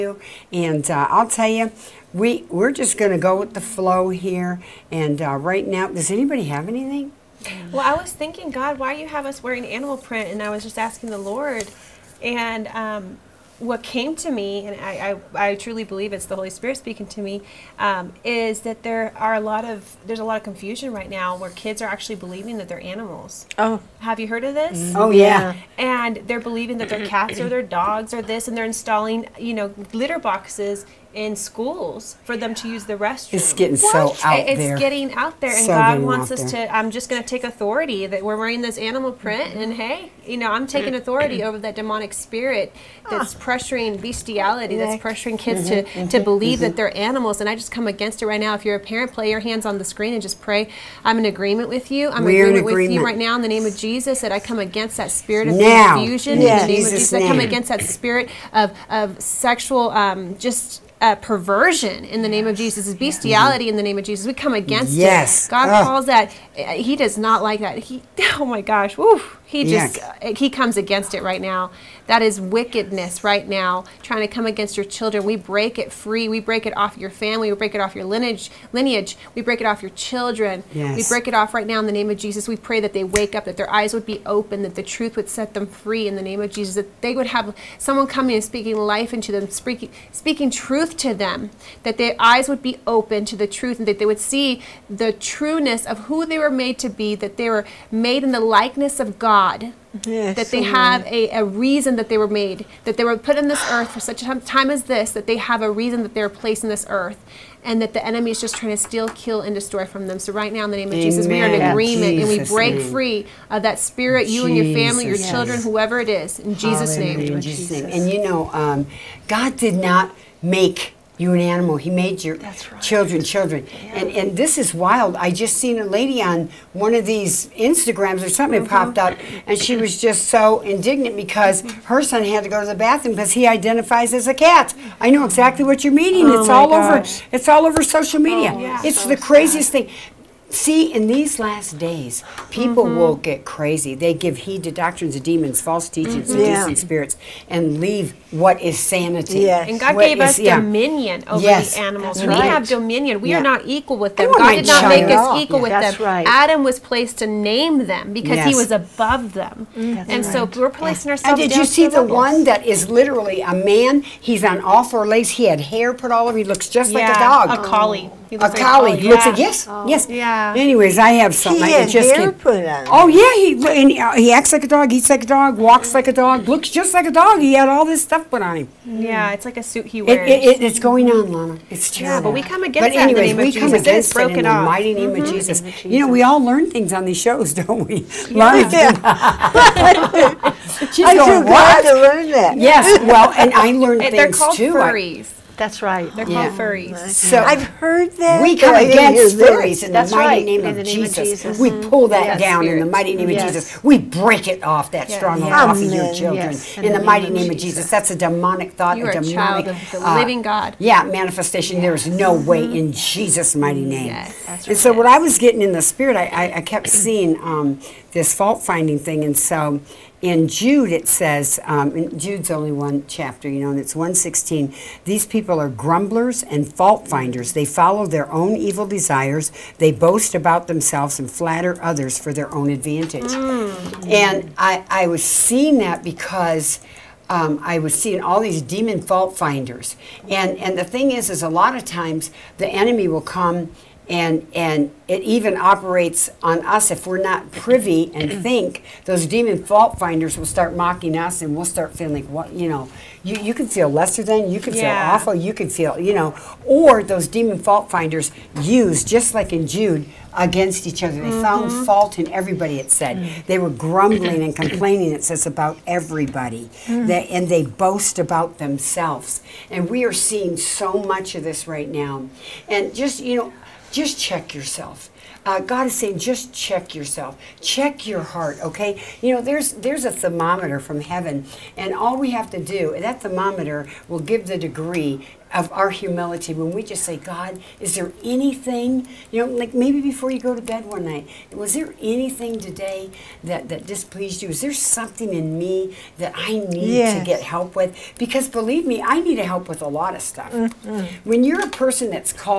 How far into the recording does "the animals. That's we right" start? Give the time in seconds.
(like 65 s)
151 s.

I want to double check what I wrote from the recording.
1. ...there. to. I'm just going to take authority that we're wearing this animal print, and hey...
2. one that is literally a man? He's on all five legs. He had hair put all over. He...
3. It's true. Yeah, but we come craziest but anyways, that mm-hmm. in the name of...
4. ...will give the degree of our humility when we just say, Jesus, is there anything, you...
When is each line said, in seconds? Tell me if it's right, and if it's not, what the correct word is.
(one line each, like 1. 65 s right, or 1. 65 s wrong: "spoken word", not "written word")
1. 36 s right
2. 162 s wrong: "four", not "five"
3. 181 s wrong: "against", not "craziest"
4. 284 s wrong: "God", not "Jesus".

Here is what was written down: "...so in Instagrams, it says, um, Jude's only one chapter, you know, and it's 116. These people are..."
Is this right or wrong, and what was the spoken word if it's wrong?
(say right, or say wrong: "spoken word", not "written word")
wrong: "Jude", not "Instagrams".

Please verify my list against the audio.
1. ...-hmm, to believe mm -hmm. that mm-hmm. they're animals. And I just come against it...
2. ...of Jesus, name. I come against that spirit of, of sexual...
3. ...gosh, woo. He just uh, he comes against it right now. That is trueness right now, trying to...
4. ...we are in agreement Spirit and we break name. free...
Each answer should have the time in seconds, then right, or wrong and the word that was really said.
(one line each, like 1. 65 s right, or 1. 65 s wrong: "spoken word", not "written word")
1. 46 s right
2. 56 s right
3. 68 s wrong: "wickedness", not "trueness"
4. 111 s wrong: "Jesus", not "Spirit".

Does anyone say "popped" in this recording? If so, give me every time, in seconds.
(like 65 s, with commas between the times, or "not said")
128 s.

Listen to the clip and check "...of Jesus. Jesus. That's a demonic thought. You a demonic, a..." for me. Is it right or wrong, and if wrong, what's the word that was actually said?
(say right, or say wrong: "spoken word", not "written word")
right.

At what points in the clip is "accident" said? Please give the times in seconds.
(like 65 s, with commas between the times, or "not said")
not said.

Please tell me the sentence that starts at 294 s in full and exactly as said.
Is there something in me that I need yes.